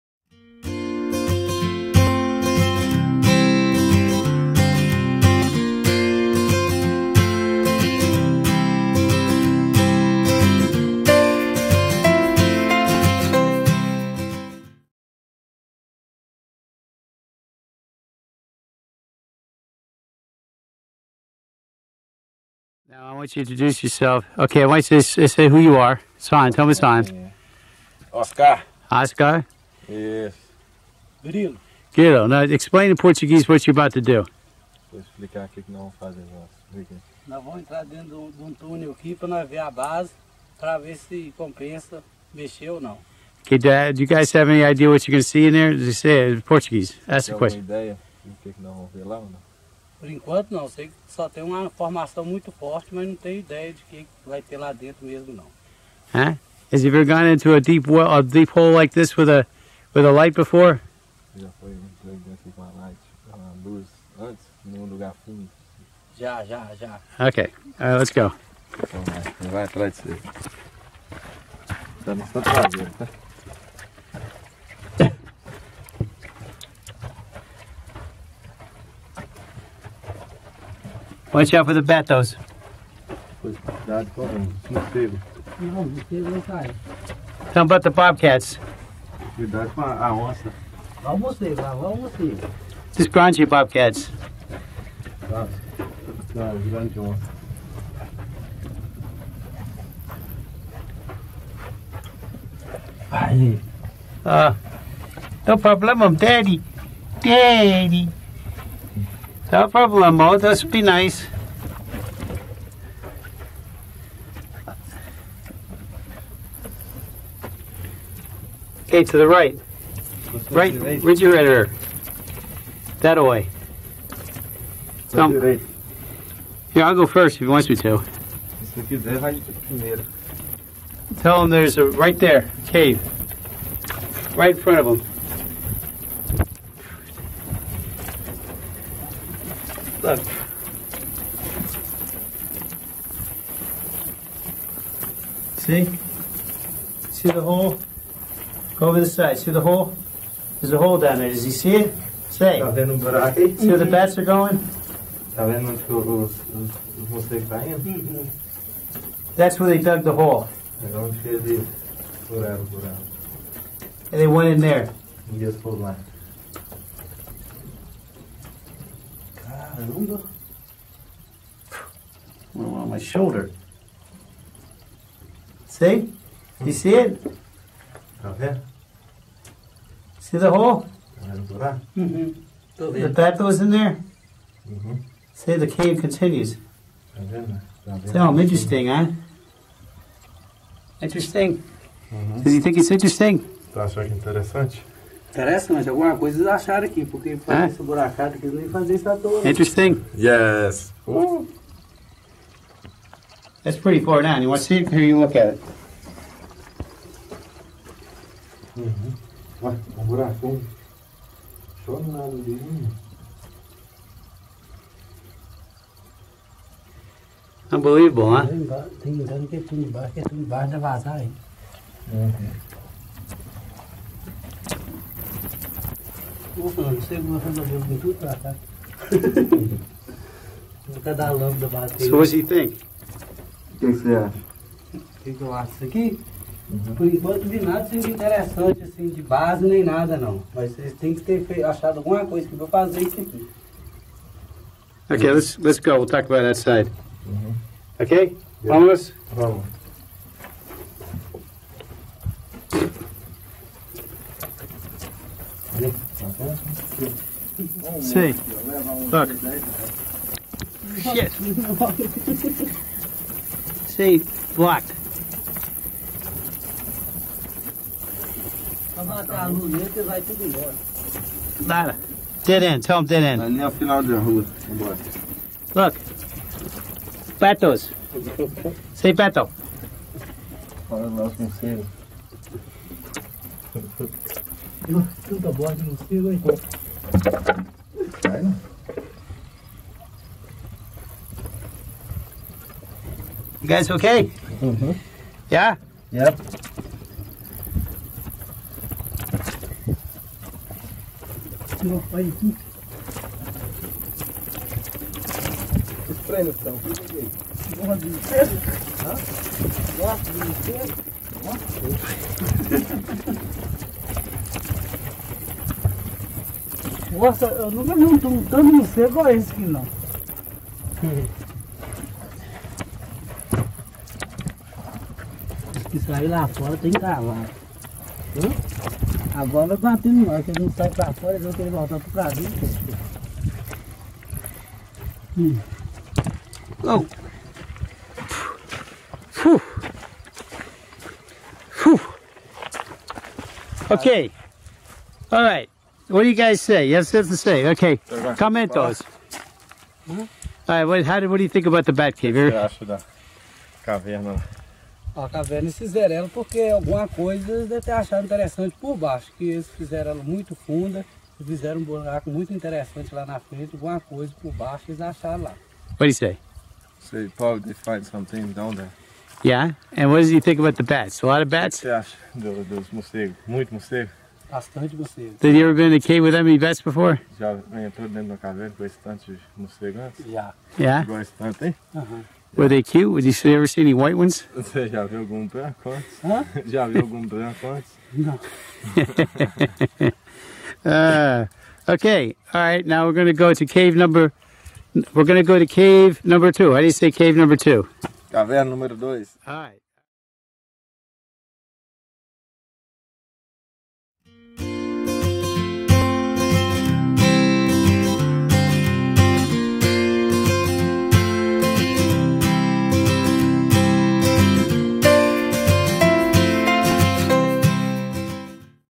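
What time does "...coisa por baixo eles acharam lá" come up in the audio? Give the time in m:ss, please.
6:04.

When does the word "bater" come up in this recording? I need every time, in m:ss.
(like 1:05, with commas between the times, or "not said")
5:29.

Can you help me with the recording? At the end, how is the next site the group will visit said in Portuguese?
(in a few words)
Caverna número dois.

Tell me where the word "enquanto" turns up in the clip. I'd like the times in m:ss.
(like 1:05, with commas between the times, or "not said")
0:50, 3:57.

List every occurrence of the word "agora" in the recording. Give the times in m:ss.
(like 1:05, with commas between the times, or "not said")
0:36, 5:29.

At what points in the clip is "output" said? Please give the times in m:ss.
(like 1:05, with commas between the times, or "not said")
not said.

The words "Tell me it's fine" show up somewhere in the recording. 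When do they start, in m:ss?
0:26.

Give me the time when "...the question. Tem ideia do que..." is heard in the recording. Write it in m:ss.
0:47.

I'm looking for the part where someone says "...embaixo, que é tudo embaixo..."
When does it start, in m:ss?
3:39.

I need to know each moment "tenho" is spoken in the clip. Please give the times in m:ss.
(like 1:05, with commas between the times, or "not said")
0:53.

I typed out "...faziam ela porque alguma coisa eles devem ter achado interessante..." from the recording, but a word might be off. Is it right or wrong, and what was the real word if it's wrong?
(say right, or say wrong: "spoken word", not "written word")
wrong: "fizeram", not "faziam".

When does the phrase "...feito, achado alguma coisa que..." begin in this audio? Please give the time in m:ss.
4:01.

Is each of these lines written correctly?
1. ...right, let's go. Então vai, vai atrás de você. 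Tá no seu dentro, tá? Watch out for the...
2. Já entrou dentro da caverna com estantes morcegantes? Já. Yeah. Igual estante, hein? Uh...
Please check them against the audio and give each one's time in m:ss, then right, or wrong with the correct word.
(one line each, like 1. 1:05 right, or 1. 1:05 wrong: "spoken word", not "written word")
1. 1:07 wrong: "traseiro", not "dentro"
2. 6:17 right.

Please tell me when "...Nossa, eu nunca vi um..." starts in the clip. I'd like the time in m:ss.
5:17.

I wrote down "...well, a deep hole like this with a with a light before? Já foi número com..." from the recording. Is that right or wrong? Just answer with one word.
wrong.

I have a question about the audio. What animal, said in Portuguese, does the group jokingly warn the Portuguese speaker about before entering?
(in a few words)
onça.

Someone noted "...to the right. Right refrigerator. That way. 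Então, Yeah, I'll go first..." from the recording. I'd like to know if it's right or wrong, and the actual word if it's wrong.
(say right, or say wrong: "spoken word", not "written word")
right.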